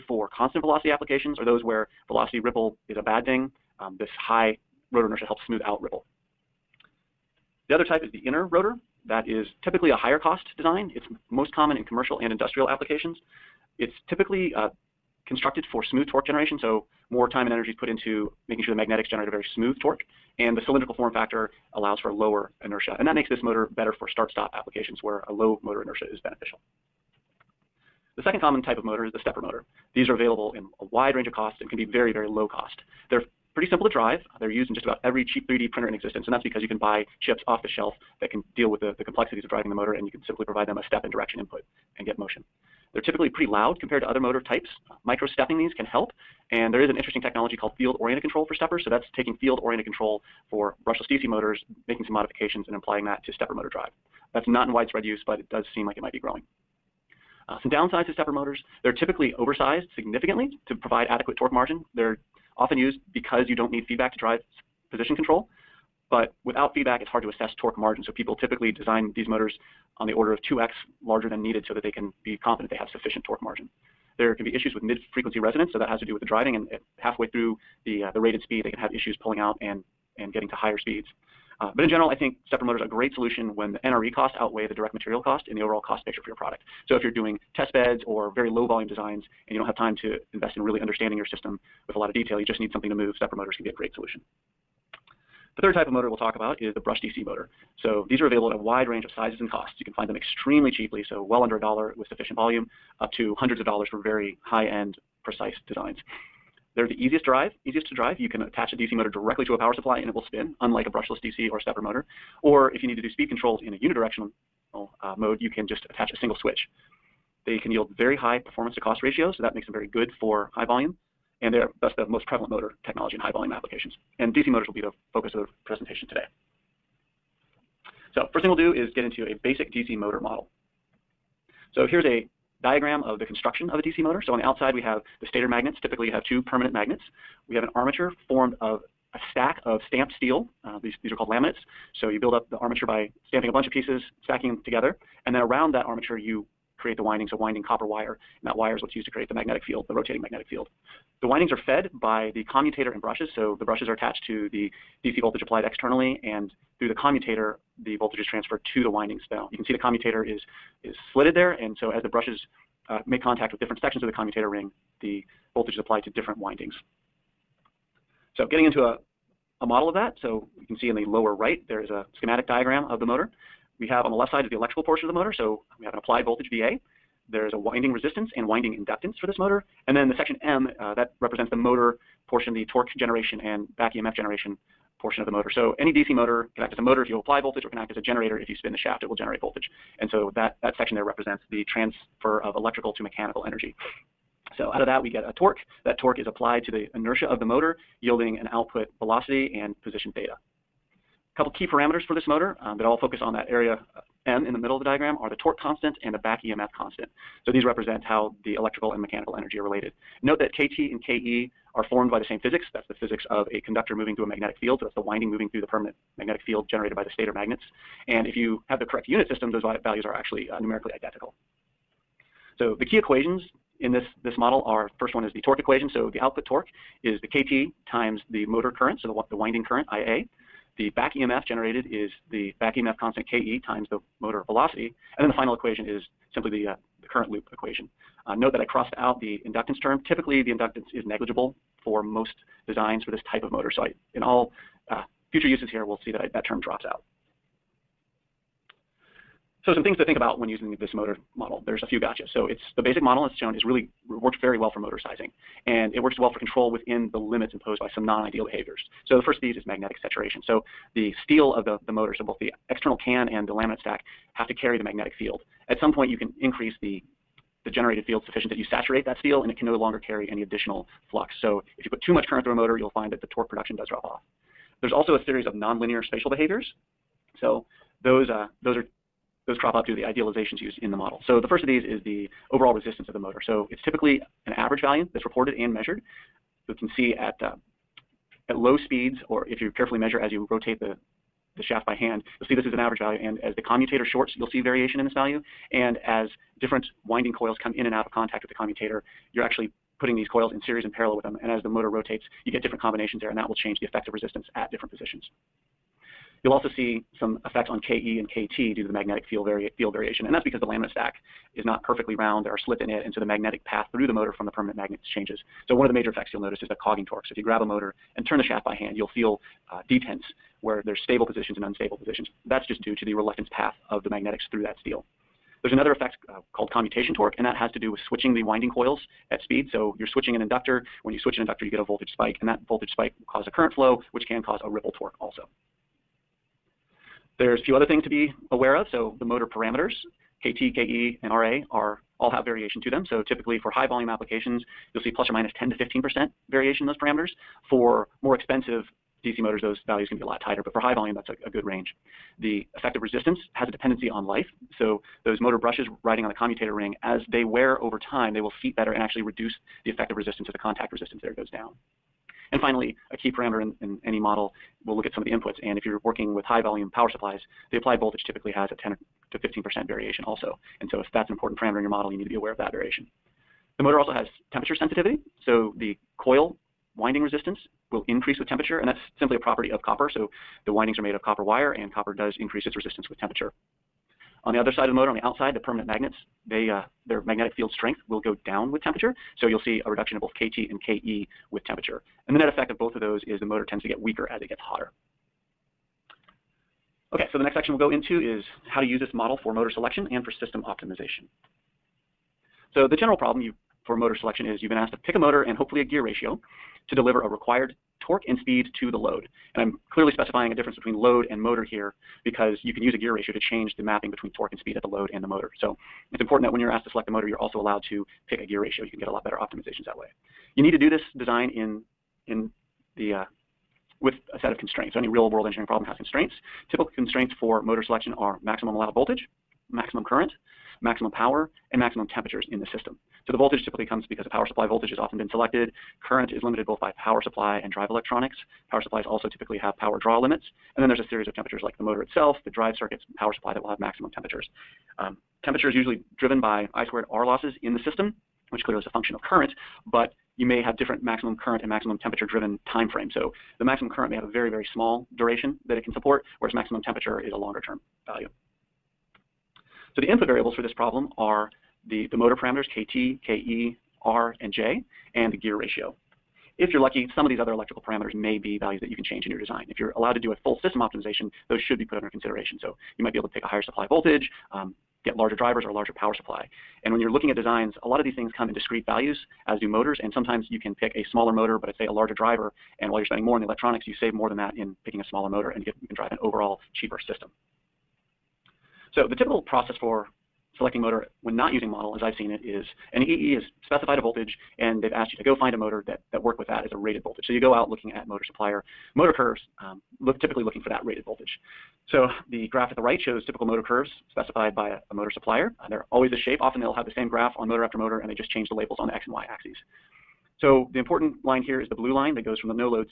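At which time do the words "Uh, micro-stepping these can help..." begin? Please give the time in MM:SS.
00:44.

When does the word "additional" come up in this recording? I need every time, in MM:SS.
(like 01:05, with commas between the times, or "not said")
04:30.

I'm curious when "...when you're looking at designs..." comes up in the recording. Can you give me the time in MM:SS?
07:56.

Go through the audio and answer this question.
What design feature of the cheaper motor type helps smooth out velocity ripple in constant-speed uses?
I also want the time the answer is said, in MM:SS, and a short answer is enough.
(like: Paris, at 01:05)
High rotor inertia, at 00:04.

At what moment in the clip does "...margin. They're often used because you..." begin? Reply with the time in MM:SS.
01:01.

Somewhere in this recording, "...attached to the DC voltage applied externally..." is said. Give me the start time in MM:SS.
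02:33.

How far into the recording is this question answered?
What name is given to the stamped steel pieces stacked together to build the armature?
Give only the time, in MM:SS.
02:21.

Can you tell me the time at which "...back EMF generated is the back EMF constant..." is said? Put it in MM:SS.
03:50.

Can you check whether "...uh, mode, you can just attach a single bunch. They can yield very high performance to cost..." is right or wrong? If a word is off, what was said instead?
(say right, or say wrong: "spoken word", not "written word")
wrong: "switch", not "bunch".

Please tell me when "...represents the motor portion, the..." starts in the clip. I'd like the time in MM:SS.
03:01.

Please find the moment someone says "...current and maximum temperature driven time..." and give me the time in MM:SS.
07:31.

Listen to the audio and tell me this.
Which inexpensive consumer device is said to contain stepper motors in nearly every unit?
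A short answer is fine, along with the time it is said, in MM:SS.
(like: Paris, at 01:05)
3D printer, at 00:35.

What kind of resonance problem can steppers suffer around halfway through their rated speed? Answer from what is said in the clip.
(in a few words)
Mid-frequency resonance.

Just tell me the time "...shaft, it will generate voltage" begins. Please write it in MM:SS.
03:08.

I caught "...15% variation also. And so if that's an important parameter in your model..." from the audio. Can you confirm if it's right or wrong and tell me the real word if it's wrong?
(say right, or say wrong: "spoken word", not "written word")
right.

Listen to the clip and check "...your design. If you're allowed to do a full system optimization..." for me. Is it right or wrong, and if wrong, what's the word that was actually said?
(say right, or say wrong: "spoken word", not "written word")
right.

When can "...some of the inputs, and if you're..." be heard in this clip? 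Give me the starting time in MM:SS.
06:05.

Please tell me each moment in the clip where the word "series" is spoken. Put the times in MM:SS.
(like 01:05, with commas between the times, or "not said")
04:35, 05:00, 07:21.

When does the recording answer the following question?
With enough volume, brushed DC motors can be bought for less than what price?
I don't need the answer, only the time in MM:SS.
01:41.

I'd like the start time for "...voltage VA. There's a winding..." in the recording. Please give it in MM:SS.
02:56.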